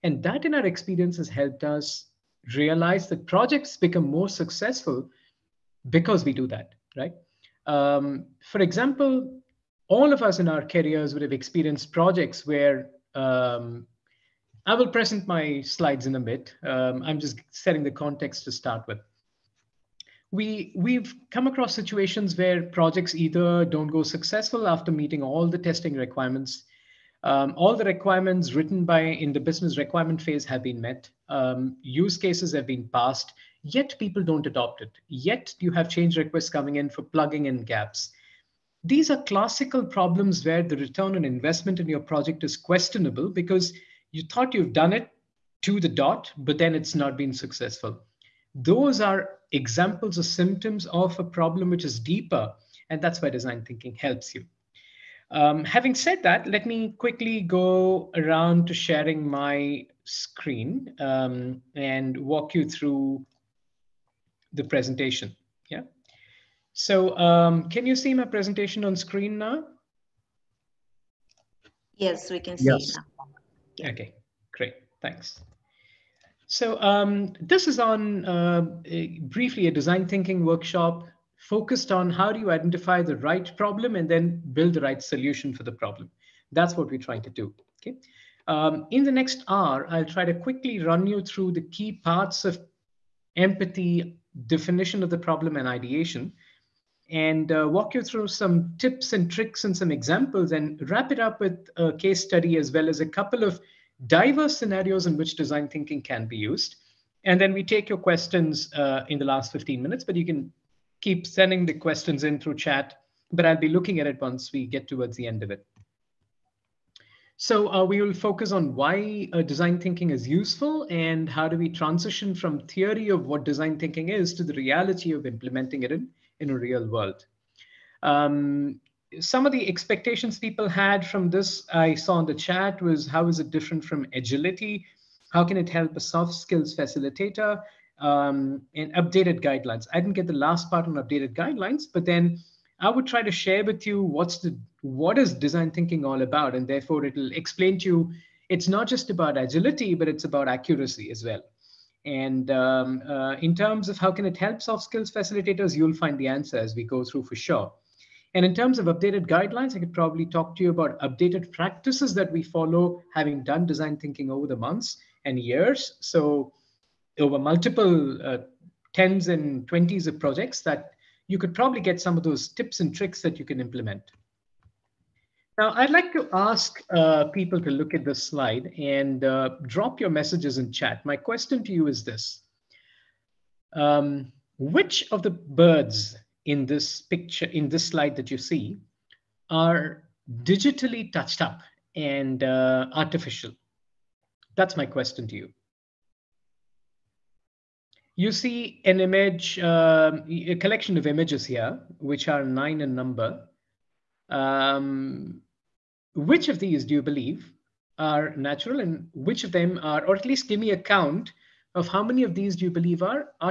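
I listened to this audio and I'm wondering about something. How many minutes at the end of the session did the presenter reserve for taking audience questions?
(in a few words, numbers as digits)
15.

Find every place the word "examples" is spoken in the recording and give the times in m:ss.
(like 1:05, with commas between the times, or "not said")
0:08, 0:49, 1:39.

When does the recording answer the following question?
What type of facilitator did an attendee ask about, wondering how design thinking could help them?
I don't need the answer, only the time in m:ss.
2:15.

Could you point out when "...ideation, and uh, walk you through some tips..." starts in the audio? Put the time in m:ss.
1:35.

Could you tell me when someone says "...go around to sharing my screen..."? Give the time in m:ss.
0:57.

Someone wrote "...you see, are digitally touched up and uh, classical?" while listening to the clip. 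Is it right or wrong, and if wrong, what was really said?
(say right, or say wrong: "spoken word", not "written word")
wrong: "artificial", not "classical".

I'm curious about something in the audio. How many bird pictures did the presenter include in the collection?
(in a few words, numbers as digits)
9.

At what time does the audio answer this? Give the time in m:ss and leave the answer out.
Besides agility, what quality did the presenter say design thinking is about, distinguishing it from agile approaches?
2:30.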